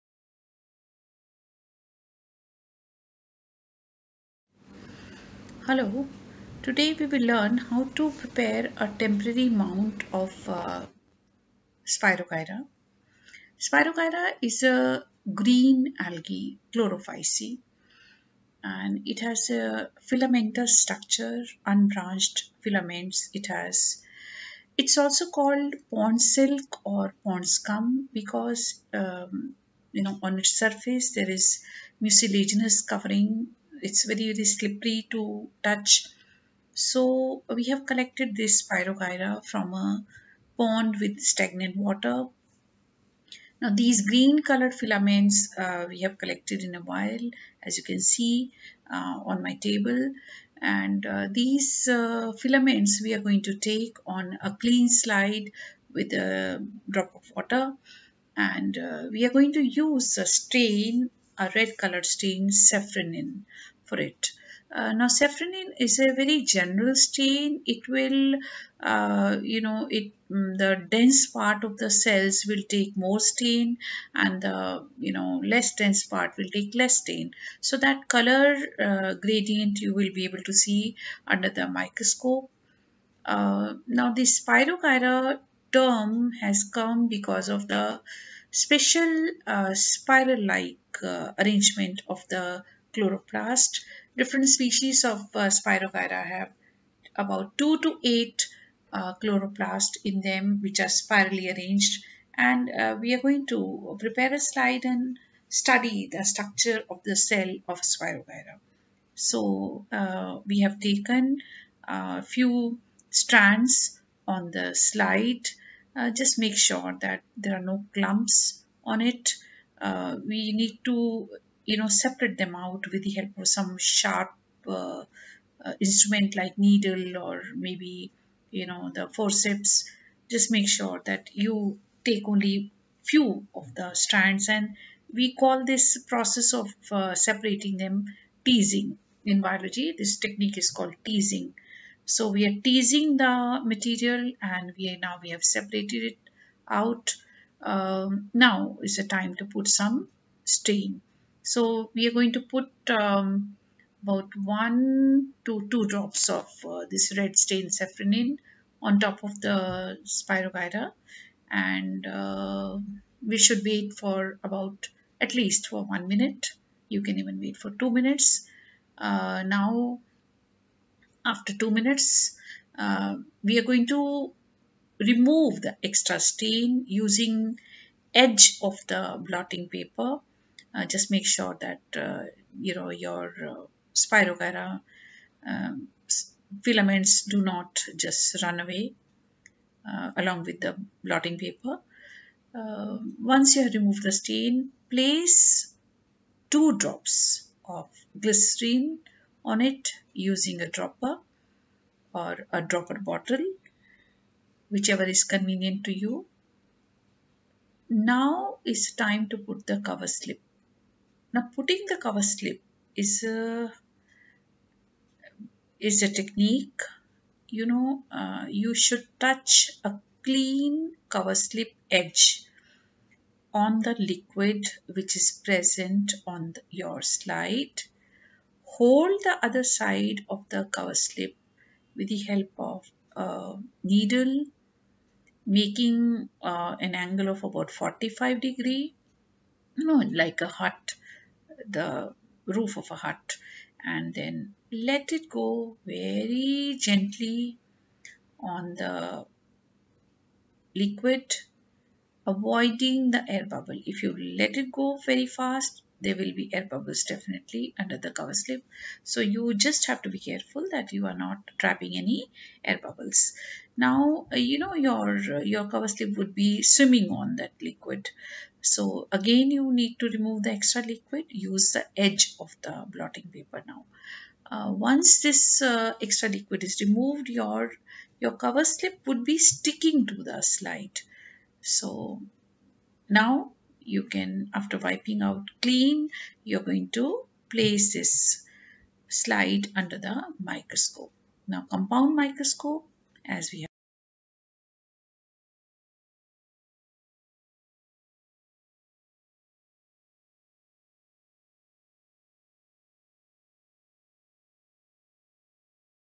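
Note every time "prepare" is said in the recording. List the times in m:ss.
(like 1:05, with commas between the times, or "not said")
0:08, 1:43.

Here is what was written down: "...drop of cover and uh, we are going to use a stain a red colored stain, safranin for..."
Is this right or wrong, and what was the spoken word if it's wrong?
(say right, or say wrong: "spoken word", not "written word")
wrong: "water", not "cover".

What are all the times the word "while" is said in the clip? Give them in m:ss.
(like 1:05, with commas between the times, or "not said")
0:46.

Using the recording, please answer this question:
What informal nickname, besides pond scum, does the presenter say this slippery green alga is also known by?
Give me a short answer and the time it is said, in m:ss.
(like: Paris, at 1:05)
pond silk, at 0:25.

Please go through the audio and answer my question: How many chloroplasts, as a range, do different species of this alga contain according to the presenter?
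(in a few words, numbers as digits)
2 to 8.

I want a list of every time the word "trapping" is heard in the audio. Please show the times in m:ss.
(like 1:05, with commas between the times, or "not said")
4:21.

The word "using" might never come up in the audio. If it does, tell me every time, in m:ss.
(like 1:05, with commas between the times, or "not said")
2:56, 3:20.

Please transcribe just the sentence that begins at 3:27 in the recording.
Now is time to put the cover slip now putting the cover slip is a is a technique.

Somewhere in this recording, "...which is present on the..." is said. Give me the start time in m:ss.
3:44.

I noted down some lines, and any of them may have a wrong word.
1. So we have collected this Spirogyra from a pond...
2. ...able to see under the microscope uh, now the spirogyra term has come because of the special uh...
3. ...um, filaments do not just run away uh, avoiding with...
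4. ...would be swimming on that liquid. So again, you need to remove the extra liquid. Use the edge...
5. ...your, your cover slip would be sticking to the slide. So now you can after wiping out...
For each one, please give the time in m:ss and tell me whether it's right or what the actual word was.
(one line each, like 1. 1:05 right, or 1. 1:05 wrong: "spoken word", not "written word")
1. 0:36 right
2. 1:20 right
3. 3:05 wrong: "along", not "avoiding"
4. 4:26 right
5. 4:37 right.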